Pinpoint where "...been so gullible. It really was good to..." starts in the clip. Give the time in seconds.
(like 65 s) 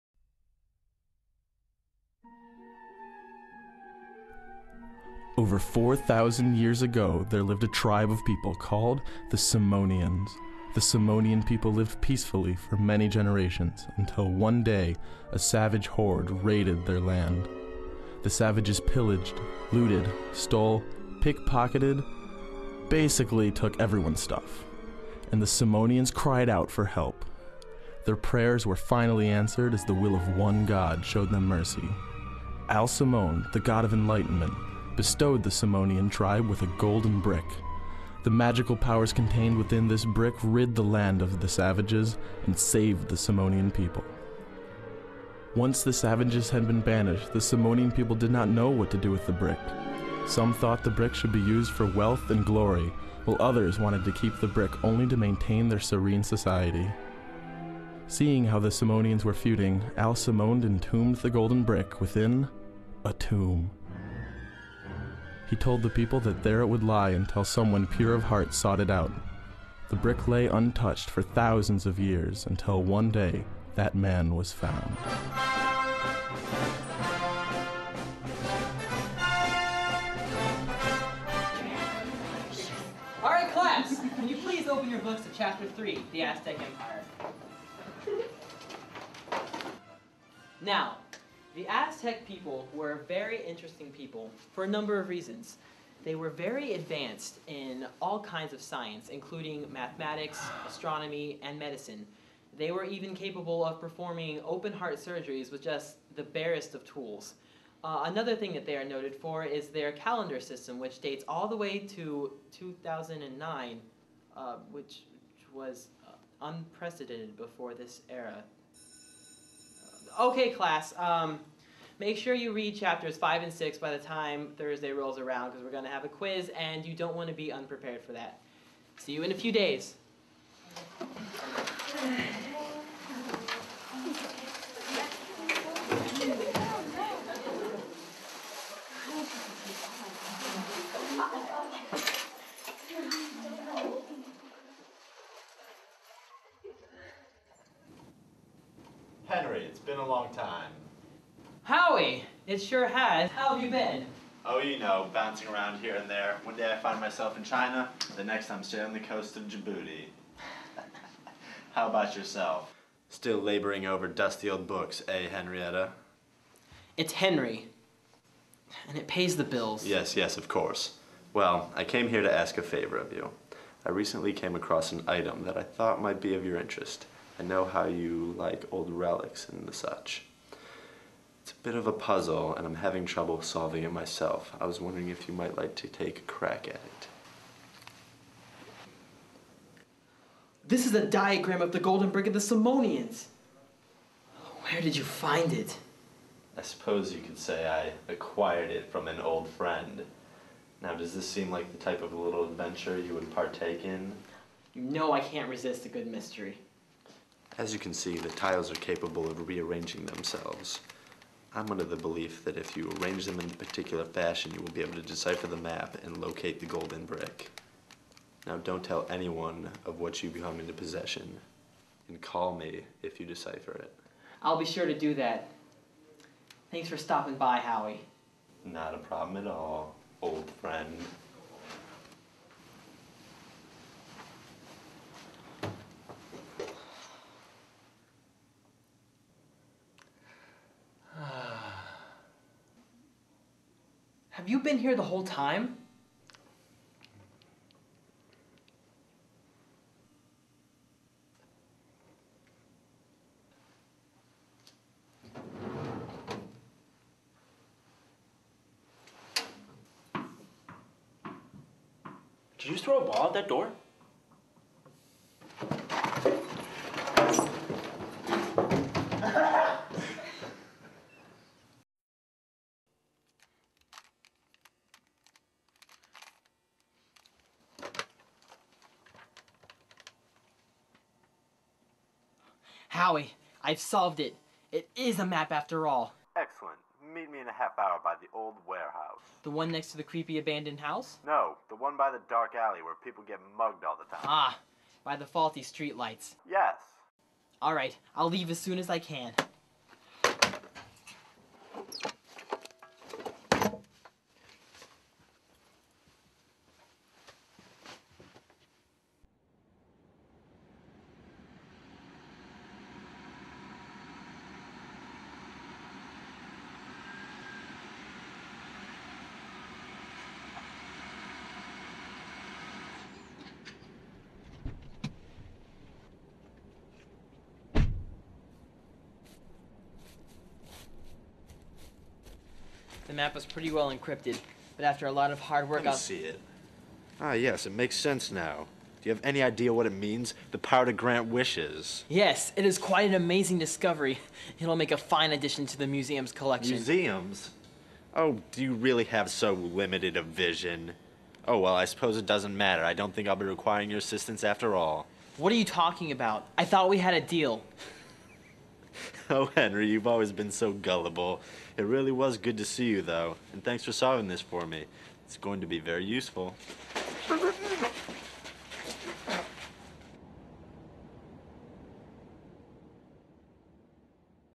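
360 s.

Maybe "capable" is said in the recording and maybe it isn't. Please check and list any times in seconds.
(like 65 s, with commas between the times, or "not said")
103 s, 208 s.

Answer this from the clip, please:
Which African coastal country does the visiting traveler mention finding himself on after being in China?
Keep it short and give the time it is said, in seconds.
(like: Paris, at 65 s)
Djibouti, at 159 s.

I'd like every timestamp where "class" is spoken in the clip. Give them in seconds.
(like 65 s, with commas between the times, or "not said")
83 s, 120 s.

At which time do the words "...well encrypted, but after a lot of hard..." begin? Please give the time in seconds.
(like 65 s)
333 s.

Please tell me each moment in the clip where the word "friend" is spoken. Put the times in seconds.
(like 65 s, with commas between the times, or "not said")
199 s, 230 s.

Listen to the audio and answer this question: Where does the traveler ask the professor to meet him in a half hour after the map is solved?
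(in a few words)
the old warehouse.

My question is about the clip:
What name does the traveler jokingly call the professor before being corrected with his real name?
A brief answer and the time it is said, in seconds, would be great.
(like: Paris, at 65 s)
Henrietta, at 165 s.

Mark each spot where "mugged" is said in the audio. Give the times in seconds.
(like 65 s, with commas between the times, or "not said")
293 s.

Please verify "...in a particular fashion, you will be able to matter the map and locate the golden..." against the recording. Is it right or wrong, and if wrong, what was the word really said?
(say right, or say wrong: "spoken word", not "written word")
wrong: "decipher", not "matter".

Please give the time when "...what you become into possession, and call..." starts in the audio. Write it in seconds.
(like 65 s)
219 s.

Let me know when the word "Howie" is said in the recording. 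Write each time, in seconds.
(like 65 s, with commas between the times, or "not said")
151 s, 227 s, 282 s.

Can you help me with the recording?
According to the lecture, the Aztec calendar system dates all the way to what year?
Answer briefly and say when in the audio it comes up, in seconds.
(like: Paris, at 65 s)
2009, at 112 s.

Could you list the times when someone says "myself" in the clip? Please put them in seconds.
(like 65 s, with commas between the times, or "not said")
156 s, 183 s.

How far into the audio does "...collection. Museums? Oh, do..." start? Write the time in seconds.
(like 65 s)
346 s.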